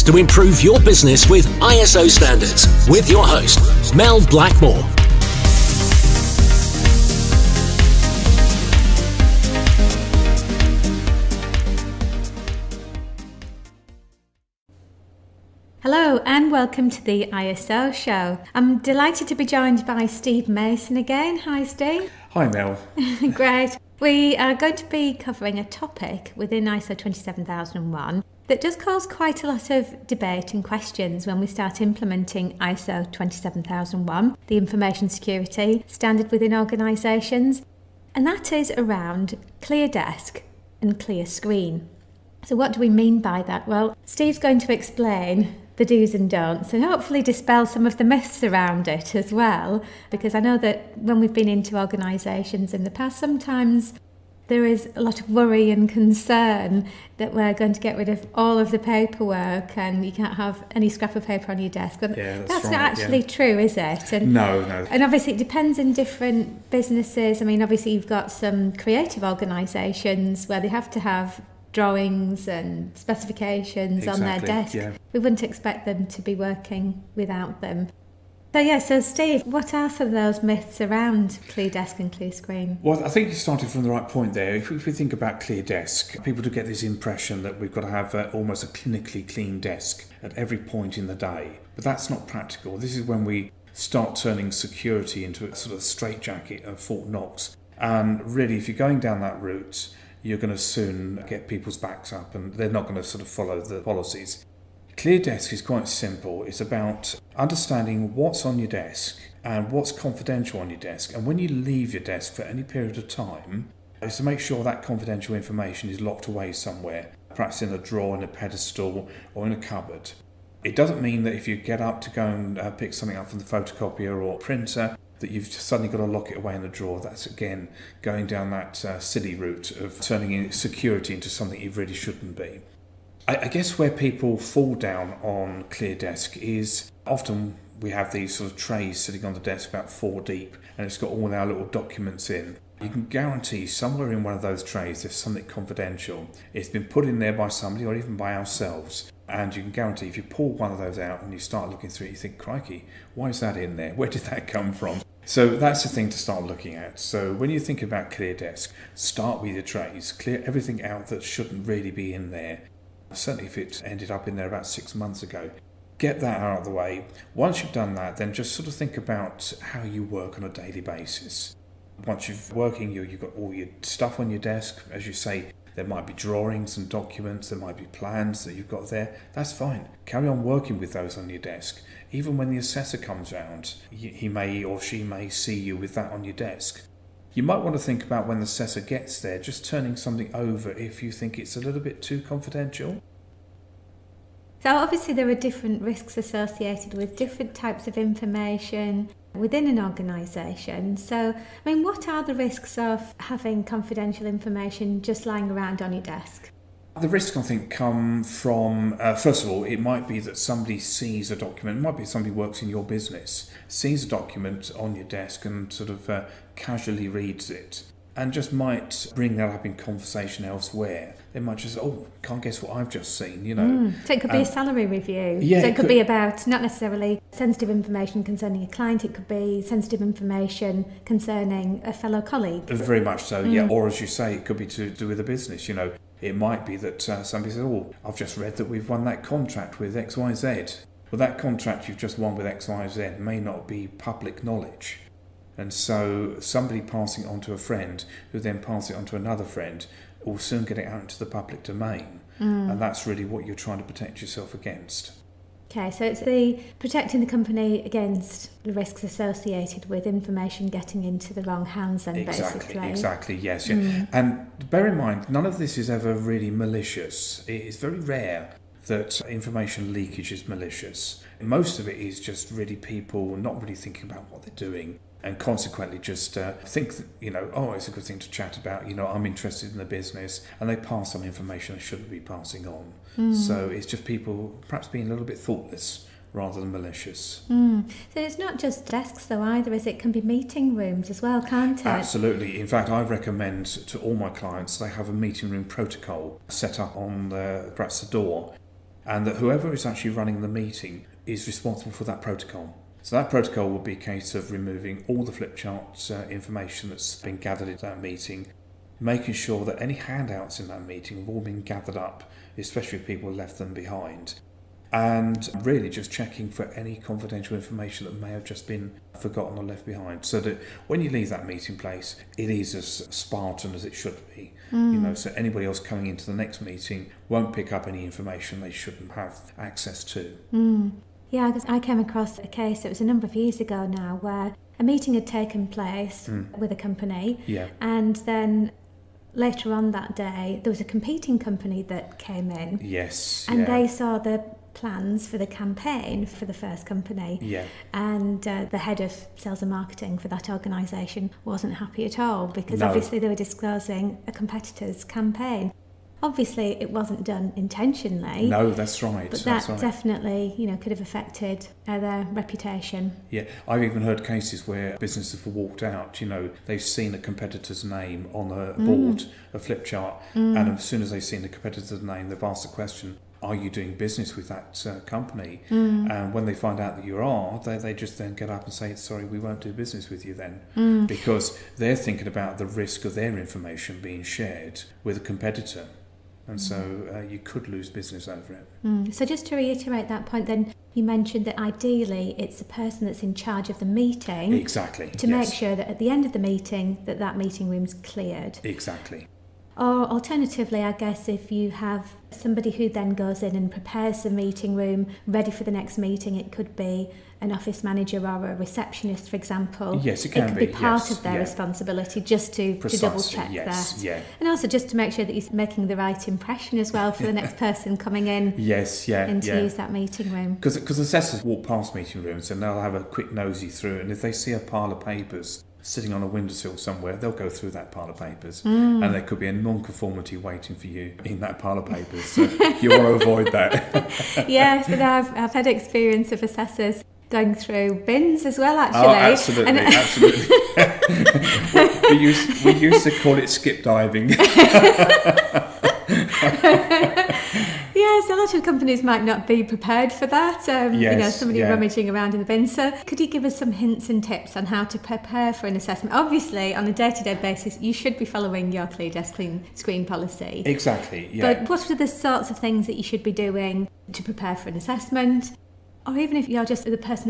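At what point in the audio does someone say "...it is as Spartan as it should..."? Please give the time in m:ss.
5:22.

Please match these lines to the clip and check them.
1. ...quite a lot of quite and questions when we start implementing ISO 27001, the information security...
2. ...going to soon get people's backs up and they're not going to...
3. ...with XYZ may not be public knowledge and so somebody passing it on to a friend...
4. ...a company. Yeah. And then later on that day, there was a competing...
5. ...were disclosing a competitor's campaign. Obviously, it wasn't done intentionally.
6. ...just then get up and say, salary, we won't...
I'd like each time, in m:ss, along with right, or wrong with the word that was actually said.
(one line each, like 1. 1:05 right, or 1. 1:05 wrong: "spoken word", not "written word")
1. 0:29 wrong: "debate", not "quite"
2. 1:40 right
3. 4:02 right
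4. 5:36 right
5. 5:53 right
6. 6:17 wrong: "sorry", not "salary".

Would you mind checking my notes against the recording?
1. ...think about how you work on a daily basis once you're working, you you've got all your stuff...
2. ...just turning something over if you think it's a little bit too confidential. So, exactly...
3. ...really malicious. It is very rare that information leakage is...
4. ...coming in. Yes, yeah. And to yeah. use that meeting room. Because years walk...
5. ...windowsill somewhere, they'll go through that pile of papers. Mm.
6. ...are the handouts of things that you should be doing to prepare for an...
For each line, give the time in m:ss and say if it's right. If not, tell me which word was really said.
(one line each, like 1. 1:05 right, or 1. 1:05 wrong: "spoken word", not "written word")
1. 2:48 right
2. 3:09 wrong: "obviously", not "exactly"
3. 4:26 right
4. 6:57 wrong: "assessors", not "years"
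5. 7:06 right
6. 7:41 wrong: "sorts", not "handouts".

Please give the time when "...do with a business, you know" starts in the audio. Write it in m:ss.
3:54.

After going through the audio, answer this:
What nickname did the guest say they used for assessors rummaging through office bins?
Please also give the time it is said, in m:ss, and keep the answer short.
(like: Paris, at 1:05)
skip diving, at 7:23.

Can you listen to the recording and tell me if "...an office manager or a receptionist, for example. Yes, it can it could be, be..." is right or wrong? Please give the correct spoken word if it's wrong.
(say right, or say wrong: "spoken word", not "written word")
right.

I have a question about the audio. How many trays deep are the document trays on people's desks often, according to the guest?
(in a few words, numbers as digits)
four.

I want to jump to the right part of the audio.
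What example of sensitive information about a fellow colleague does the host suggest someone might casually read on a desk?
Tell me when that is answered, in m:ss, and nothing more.
3:44.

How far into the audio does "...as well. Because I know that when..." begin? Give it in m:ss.
0:49.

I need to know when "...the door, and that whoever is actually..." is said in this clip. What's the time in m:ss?
4:58.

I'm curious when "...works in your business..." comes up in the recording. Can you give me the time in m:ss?
3:32.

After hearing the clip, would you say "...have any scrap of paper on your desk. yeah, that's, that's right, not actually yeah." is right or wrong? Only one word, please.
right.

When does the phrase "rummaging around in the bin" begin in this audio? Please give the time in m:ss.
7:31.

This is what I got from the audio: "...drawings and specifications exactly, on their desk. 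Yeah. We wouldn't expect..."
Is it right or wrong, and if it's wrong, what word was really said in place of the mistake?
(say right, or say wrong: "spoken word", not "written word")
right.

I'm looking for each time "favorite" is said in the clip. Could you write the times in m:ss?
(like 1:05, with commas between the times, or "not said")
not said.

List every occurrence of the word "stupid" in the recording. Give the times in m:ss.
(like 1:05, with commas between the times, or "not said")
not said.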